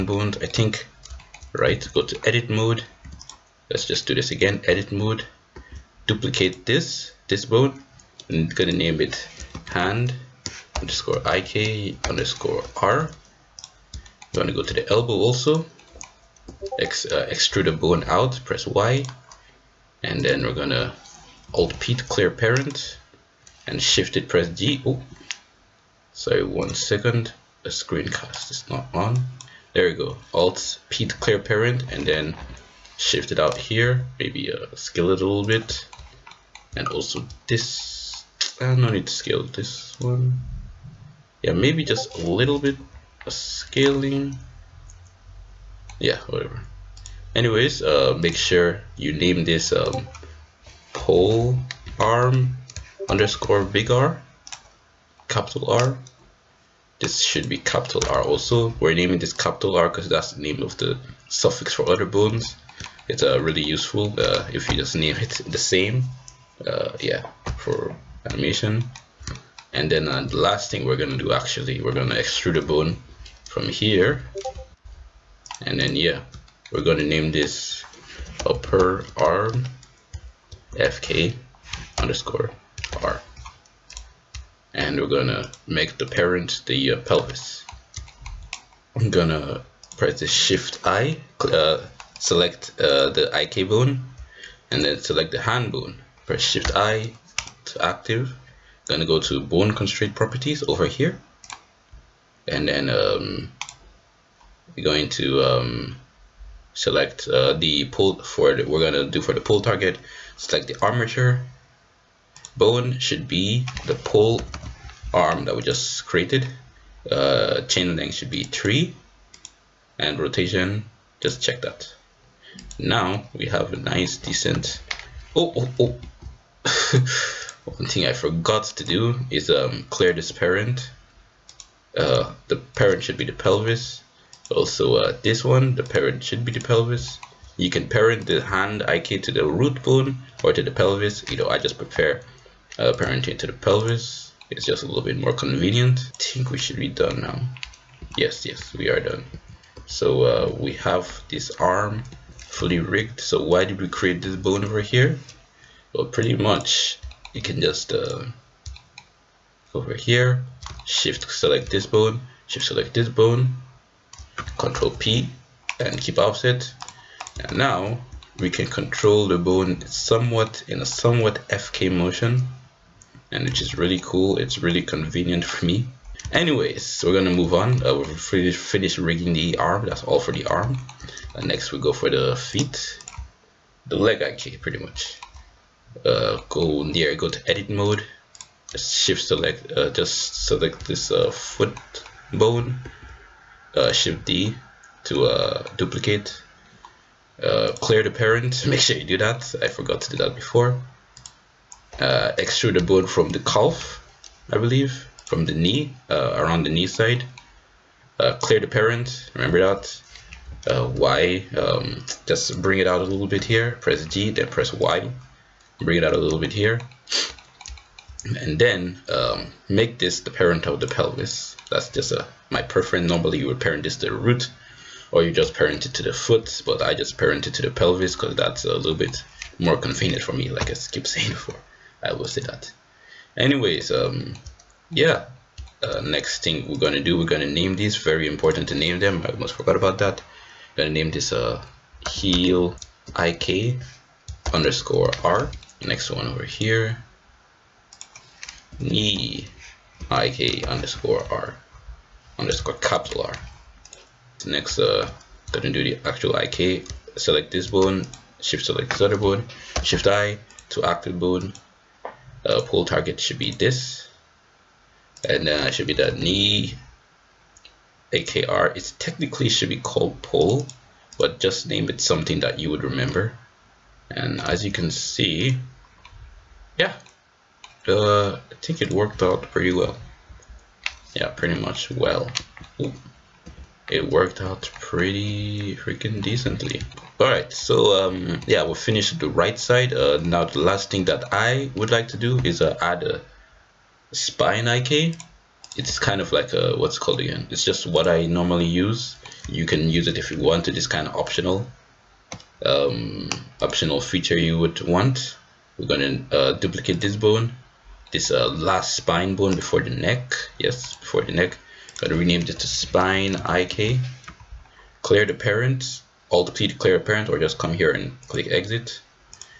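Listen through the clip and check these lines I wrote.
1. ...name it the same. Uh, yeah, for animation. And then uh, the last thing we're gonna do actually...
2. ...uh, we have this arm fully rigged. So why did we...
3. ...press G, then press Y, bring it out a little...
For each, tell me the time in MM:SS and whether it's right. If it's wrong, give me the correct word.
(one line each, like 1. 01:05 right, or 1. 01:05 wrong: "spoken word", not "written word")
1. 01:04 right
2. 02:30 right
3. 03:33 right.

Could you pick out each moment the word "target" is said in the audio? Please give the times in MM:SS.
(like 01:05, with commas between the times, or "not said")
01:49, 04:22.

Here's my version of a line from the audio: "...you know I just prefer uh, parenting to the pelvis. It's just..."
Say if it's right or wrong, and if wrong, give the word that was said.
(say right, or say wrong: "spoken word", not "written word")
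right.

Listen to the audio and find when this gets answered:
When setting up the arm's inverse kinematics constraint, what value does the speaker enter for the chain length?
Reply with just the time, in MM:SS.
01:57.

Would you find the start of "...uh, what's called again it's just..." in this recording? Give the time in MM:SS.
04:56.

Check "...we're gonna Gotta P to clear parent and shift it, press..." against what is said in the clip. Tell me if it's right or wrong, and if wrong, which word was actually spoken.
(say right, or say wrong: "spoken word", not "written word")
wrong: "Alt", not "Gotta".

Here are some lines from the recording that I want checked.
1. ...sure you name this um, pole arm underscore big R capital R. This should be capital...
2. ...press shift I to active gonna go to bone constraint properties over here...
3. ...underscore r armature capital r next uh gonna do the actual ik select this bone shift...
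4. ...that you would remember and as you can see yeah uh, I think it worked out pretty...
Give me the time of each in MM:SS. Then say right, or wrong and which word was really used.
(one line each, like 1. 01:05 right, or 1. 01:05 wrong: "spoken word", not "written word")
1. 00:48 right
2. 01:36 right
3. 04:10 wrong: "underscore", not "armature"
4. 04:32 right.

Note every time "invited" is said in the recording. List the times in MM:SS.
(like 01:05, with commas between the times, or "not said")
not said.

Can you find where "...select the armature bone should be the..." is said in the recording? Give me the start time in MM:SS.
01:50.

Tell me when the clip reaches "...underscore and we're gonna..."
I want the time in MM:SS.
01:22.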